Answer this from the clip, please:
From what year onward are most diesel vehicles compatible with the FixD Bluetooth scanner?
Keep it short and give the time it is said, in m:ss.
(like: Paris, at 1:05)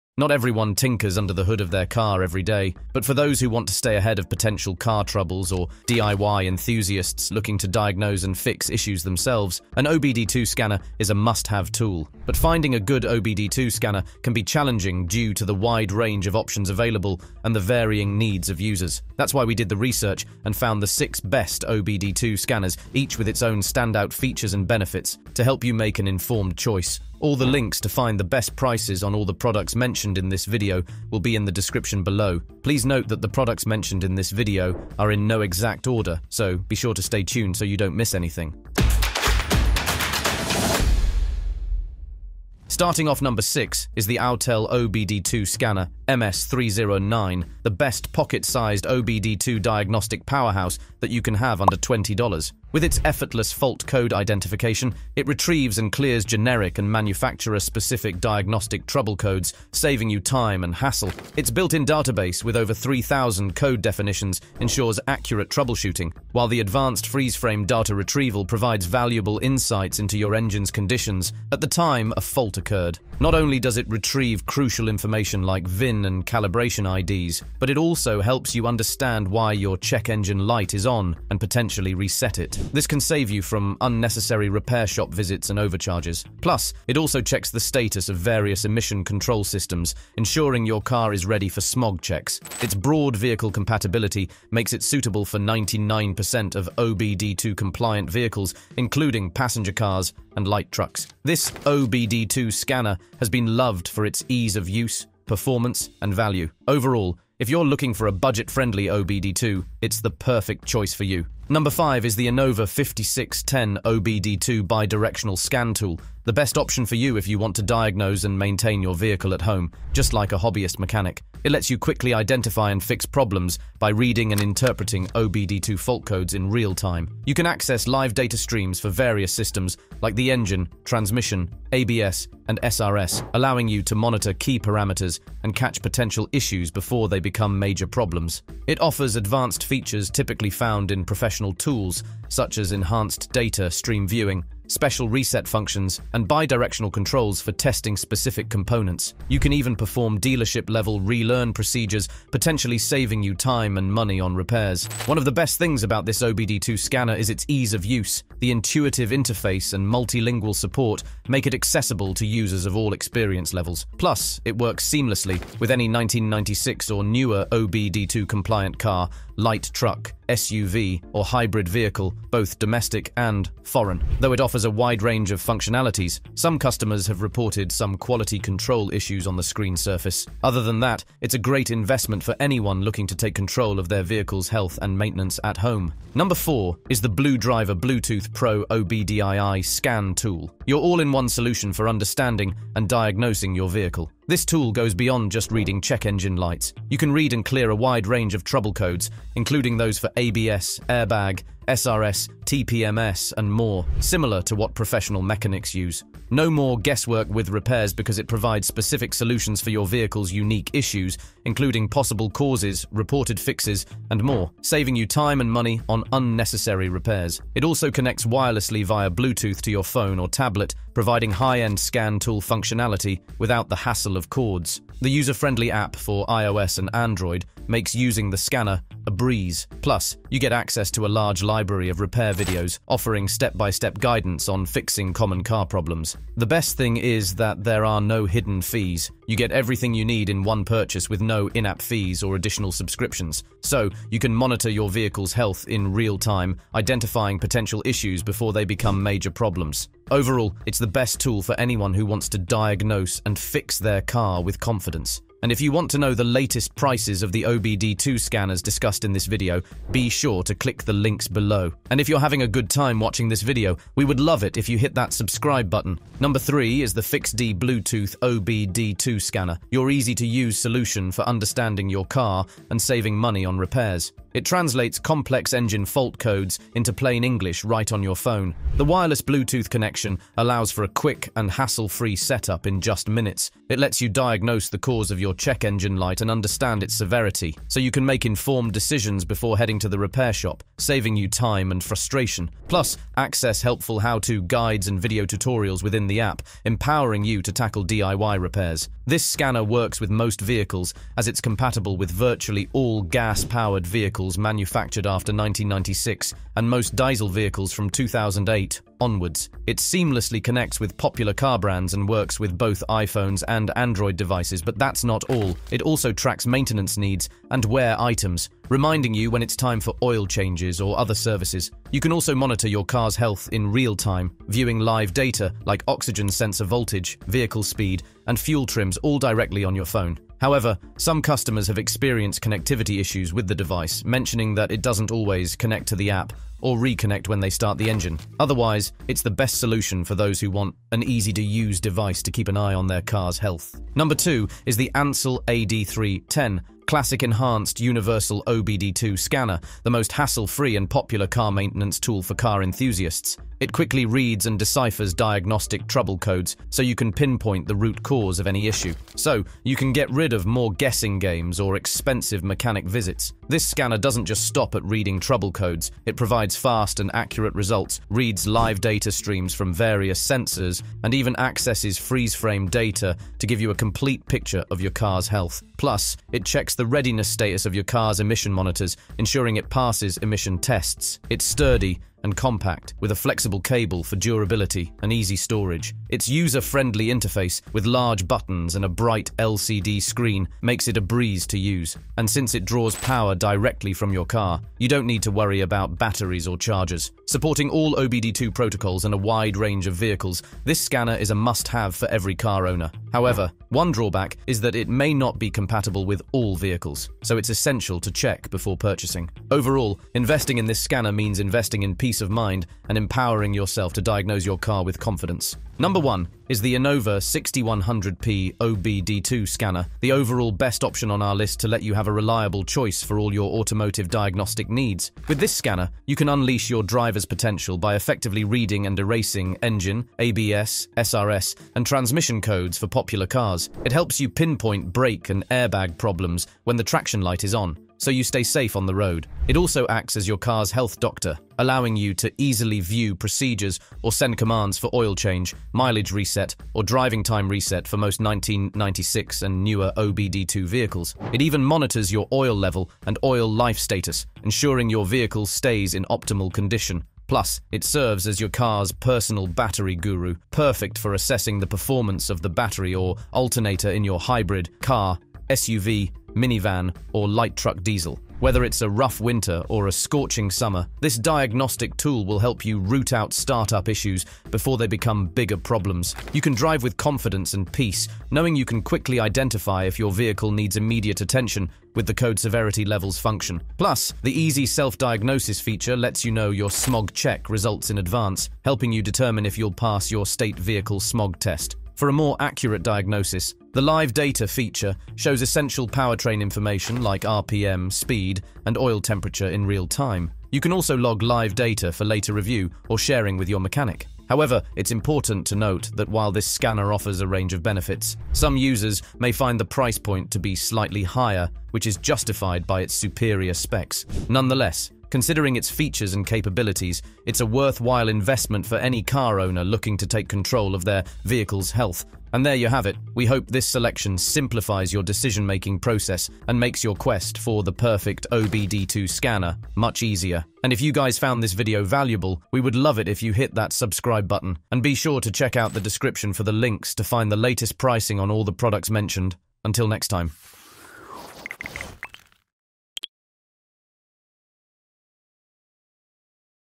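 2008, at 5:07.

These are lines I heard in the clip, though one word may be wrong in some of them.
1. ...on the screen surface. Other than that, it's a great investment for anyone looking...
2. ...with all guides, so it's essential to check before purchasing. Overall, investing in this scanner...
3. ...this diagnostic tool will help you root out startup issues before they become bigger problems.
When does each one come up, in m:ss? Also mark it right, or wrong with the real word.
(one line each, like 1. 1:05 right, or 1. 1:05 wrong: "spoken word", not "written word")
1. 2:59 right
2. 6:46 wrong: "vehicles", not "guides"
3. 7:50 right.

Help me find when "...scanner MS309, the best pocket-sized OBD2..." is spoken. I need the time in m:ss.
0:45.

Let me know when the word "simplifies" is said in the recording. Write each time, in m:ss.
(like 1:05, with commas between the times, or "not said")
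8:44.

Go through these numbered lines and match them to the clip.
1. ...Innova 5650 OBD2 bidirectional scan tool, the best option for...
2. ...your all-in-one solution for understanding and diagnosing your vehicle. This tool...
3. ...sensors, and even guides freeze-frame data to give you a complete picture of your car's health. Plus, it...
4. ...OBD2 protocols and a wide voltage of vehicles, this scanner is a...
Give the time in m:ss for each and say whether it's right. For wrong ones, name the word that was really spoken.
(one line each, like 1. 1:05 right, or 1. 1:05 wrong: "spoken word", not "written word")
1. 1:52 wrong: "5610", not "5650"
2. 3:10 right
3. 6:10 wrong: "accesses", not "guides"
4. 6:37 wrong: "range", not "voltage".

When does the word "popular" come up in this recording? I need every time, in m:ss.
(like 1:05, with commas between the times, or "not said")
5:10, 5:50, 7:12.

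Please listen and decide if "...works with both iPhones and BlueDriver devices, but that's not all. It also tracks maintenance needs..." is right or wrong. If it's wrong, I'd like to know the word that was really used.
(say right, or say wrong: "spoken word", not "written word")
wrong: "Android", not "BlueDriver".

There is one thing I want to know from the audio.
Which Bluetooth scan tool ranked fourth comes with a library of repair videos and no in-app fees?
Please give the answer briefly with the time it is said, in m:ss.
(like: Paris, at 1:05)
BlueDriver, at 3:07.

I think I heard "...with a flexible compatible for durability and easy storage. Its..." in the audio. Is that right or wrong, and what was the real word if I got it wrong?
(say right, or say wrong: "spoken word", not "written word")
wrong: "cable", not "compatible".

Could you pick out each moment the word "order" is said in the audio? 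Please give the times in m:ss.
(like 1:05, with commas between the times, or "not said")
0:35.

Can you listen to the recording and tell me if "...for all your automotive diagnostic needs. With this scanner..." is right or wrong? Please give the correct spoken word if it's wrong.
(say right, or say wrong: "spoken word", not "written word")
right.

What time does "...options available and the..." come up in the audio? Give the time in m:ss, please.
0:16.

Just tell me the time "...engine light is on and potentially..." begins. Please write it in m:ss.
1:20.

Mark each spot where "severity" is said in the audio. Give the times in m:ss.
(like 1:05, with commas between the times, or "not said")
4:46, 8:02.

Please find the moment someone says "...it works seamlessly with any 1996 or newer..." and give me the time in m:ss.
2:44.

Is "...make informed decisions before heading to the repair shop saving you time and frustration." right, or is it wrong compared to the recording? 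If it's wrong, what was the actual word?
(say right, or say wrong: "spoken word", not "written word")
right.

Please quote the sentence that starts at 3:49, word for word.
Plus, you get access to a large library of repair videos offering step-by-step -step guidance on fixing common car problems.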